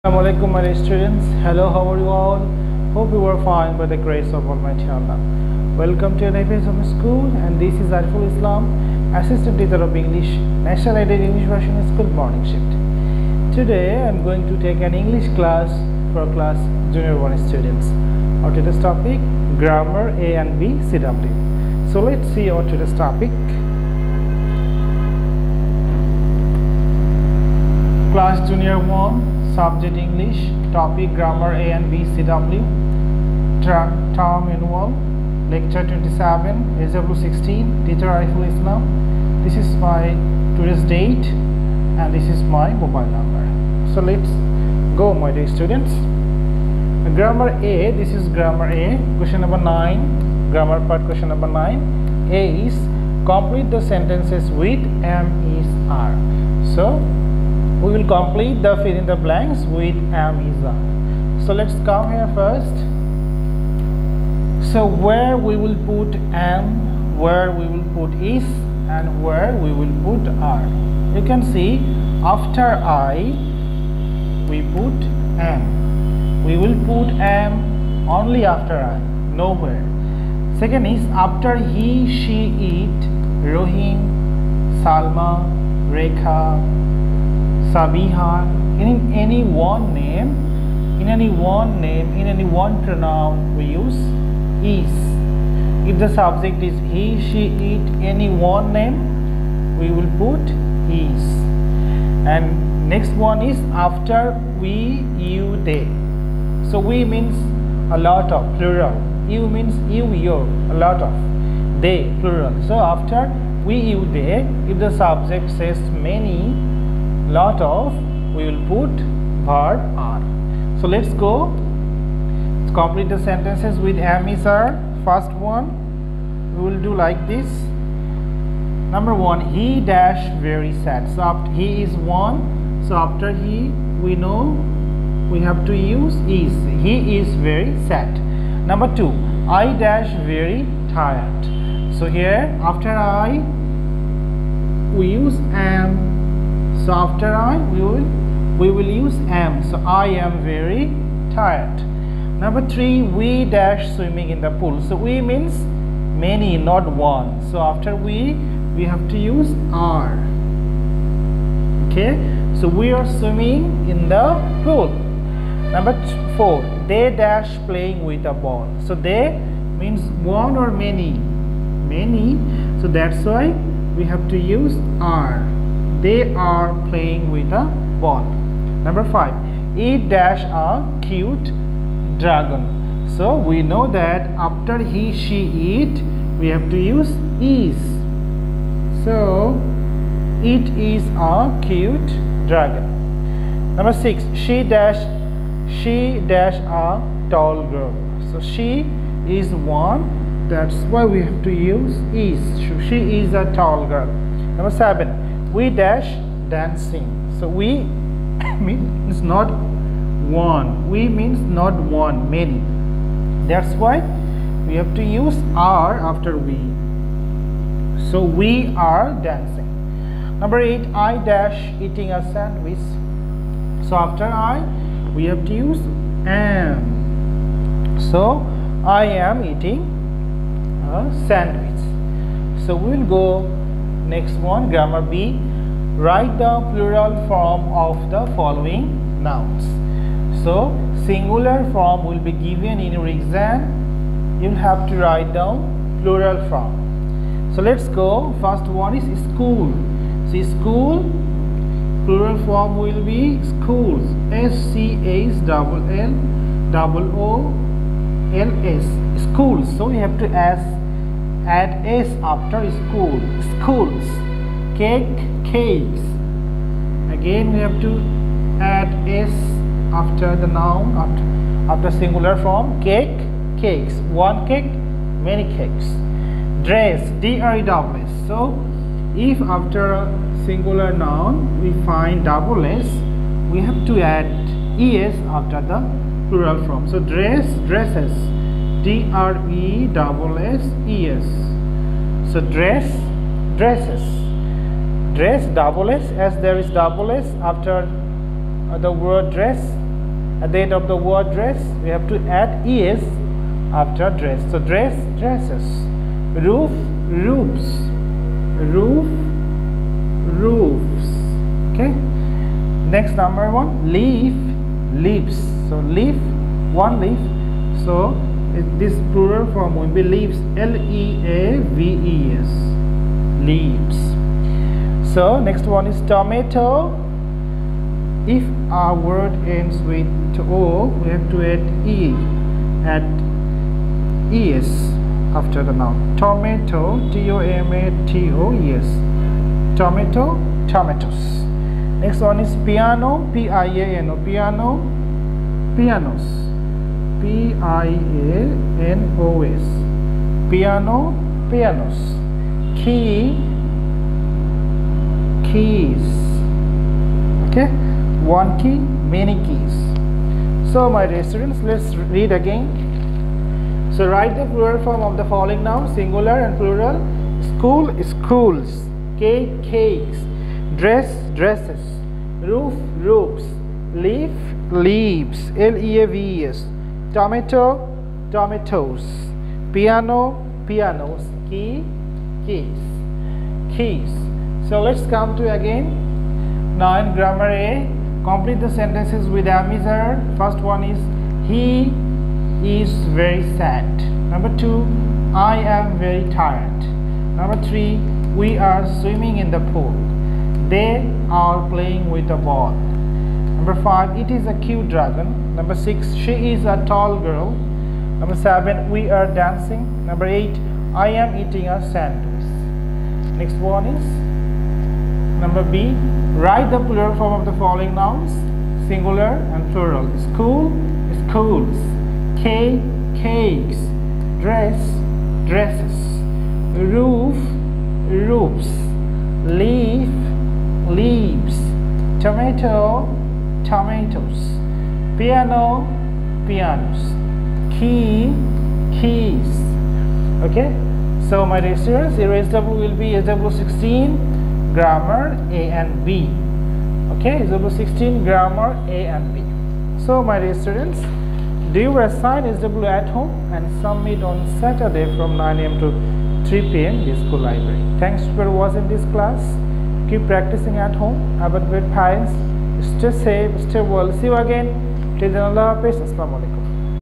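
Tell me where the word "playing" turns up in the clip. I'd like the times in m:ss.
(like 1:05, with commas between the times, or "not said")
2:47, 2:56, 6:41.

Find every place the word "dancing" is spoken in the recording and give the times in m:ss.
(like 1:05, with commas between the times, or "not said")
3:26, 3:39, 6:49.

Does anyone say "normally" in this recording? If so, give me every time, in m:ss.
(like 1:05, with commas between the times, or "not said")
not said.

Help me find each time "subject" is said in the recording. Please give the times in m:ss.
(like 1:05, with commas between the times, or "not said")
0:29, 1:36, 1:54.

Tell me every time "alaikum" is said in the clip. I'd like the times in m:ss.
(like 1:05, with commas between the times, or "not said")
0:00, 7:46.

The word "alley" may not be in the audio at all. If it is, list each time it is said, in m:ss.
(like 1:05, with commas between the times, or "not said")
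not said.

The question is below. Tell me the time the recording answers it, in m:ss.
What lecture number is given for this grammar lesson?
0:35.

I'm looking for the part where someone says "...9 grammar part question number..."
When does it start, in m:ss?
0:49.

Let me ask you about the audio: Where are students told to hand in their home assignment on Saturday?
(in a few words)
school library.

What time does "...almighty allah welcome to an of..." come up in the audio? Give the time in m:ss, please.
0:04.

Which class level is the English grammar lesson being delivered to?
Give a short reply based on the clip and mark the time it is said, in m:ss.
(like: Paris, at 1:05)
Junior 1, at 0:16.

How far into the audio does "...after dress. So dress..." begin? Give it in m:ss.
5:03.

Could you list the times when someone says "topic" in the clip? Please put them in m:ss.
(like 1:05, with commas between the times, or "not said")
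0:18, 0:23, 0:30.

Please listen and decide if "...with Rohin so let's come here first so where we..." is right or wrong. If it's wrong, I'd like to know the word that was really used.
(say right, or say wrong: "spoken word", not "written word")
wrong: "Amazon", not "Rohin".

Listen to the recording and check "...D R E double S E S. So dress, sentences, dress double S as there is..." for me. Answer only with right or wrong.
wrong.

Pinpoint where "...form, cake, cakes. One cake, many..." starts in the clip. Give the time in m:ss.
4:32.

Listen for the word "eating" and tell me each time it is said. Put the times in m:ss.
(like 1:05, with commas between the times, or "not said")
3:41, 3:49, 6:51.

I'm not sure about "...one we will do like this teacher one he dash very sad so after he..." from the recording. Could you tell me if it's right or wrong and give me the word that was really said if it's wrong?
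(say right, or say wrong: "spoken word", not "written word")
wrong: "number", not "teacher".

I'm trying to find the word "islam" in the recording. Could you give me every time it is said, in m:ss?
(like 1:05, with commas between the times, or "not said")
0:08, 0:38.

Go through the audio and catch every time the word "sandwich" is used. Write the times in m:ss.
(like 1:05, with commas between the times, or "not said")
3:42, 3:51, 6:51.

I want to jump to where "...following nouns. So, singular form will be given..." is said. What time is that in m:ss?
3:58.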